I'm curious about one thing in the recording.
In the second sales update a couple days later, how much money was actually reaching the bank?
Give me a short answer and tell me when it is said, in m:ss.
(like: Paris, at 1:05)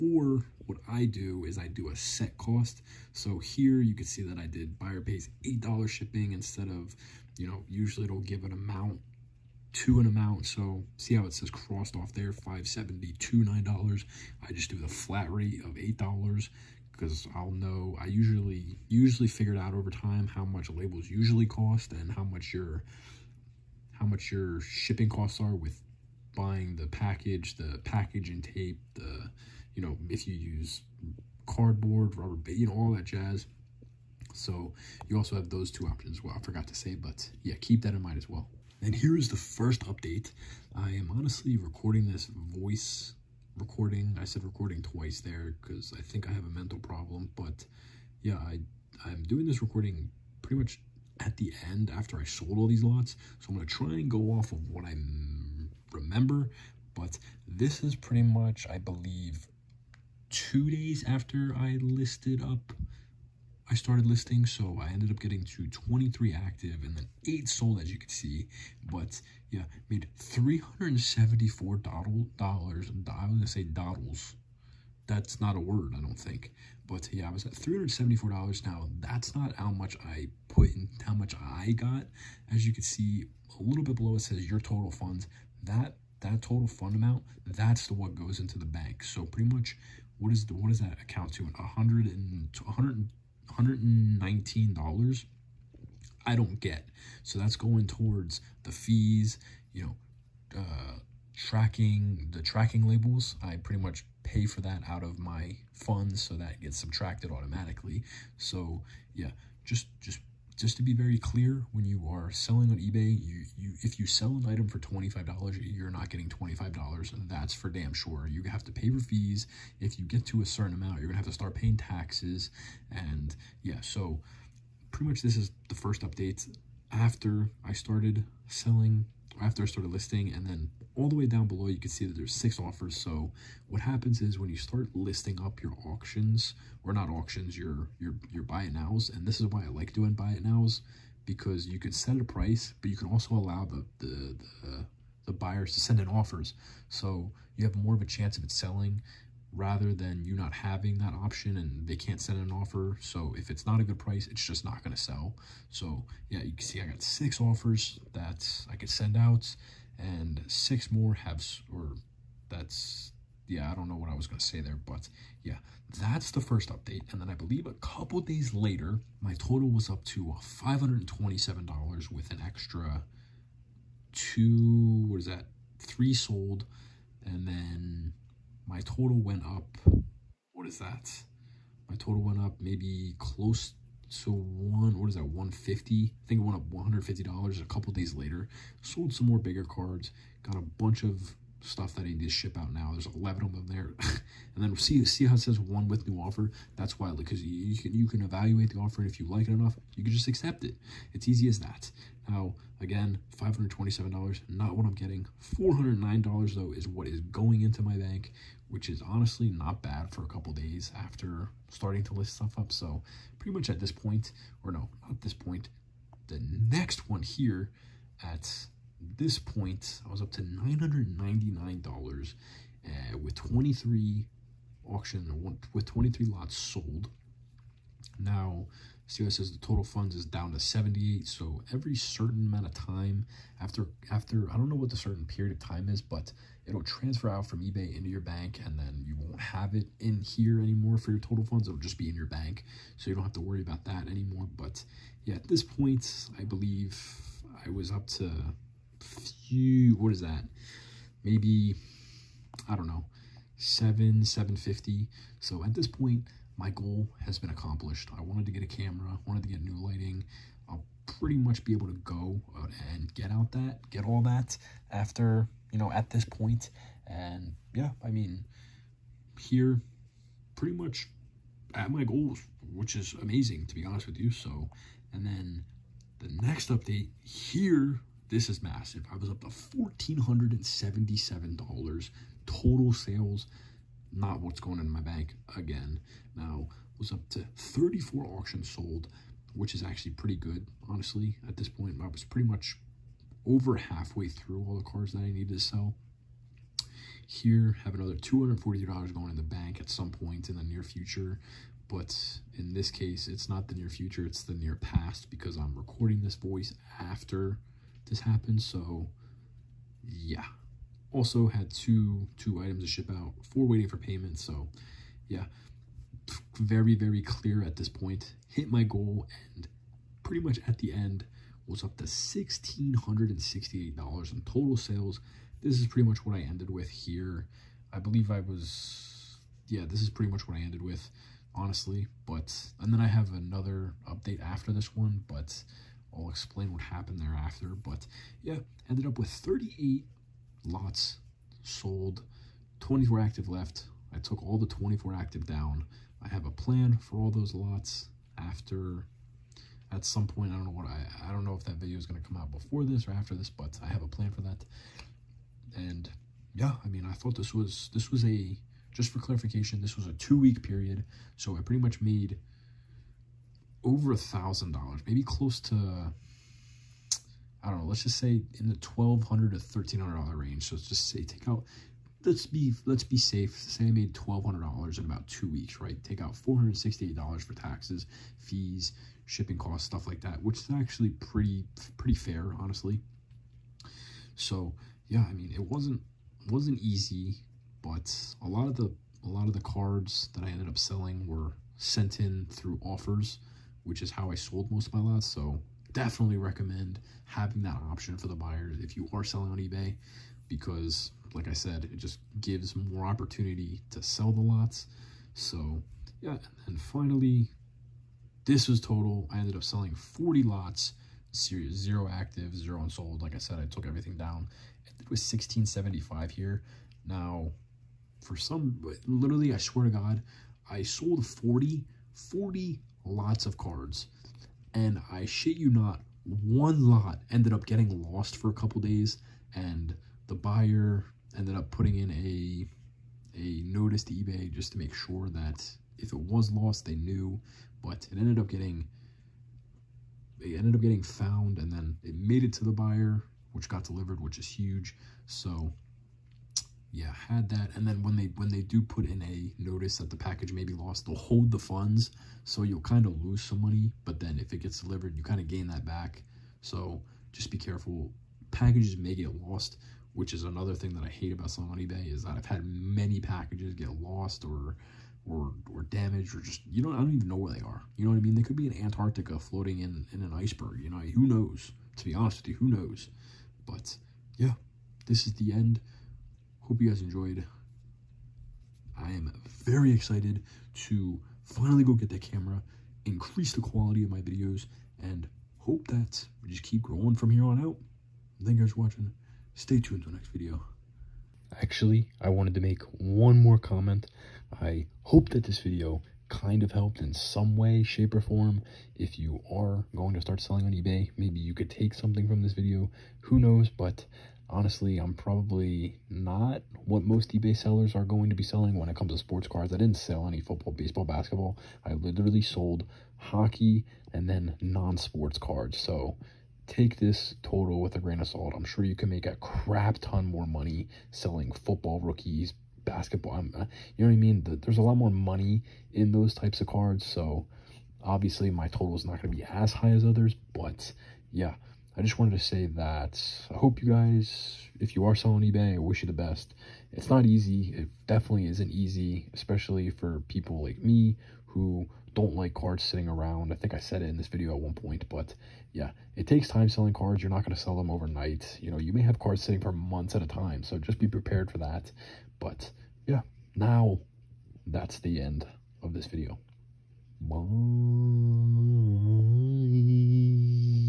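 $409, at 3:25.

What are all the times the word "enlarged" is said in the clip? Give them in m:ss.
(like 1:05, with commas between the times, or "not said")
not said.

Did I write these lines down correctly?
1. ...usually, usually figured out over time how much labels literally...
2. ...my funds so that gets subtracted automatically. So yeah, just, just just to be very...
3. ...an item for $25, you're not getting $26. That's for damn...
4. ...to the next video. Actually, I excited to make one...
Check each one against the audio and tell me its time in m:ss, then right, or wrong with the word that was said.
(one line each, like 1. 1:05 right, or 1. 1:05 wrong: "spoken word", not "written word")
1. 0:18 wrong: "usually", not "literally"
2. 1:45 right
3. 1:54 wrong: "25", not "26"
4. 8:10 wrong: "wanted", not "excited".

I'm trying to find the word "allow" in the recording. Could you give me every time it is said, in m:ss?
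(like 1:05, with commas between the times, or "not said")
2:23.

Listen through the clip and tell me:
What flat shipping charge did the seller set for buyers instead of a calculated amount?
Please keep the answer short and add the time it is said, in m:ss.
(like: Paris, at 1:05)
$8, at 0:04.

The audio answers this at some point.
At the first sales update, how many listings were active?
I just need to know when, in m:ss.
1:05.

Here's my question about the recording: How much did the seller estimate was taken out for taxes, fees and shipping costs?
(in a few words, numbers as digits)
$468.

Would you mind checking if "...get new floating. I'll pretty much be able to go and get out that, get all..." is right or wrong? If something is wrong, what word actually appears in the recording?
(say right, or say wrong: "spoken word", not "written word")
wrong: "lighting", not "floating".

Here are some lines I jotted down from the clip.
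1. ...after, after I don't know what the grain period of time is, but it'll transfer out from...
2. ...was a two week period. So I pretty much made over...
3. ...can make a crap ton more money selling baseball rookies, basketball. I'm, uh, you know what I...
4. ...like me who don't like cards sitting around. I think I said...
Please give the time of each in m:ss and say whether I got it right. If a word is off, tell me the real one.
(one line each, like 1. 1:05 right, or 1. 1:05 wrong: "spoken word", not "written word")
1. 3:53 wrong: "certain", not "grain"
2. 5:59 right
3. 8:38 wrong: "football", not "baseball"
4. 9:00 right.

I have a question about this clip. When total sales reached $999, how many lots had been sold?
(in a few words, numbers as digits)
23.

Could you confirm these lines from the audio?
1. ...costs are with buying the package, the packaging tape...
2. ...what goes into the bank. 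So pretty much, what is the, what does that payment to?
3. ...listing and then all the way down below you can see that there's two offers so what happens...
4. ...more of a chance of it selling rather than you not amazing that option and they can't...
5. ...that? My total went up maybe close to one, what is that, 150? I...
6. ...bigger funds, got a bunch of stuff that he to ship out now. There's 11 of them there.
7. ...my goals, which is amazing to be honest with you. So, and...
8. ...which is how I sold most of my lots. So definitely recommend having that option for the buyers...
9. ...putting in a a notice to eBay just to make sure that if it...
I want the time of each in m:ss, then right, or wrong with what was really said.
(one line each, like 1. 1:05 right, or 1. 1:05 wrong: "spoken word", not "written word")
1. 0:25 right
2. 1:27 wrong: "account", not "payment"
3. 2:09 wrong: "six", not "two"
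4. 2:27 wrong: "having", not "amazing"
5. 3:00 right
6. 3:09 wrong: "cards", not "funds"
7. 4:31 right
8. 6:33 right
9. 7:11 right.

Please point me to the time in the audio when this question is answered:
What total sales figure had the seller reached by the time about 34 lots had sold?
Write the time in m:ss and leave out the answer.
4:39.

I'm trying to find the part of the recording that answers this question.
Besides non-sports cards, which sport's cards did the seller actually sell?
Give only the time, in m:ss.
8:33.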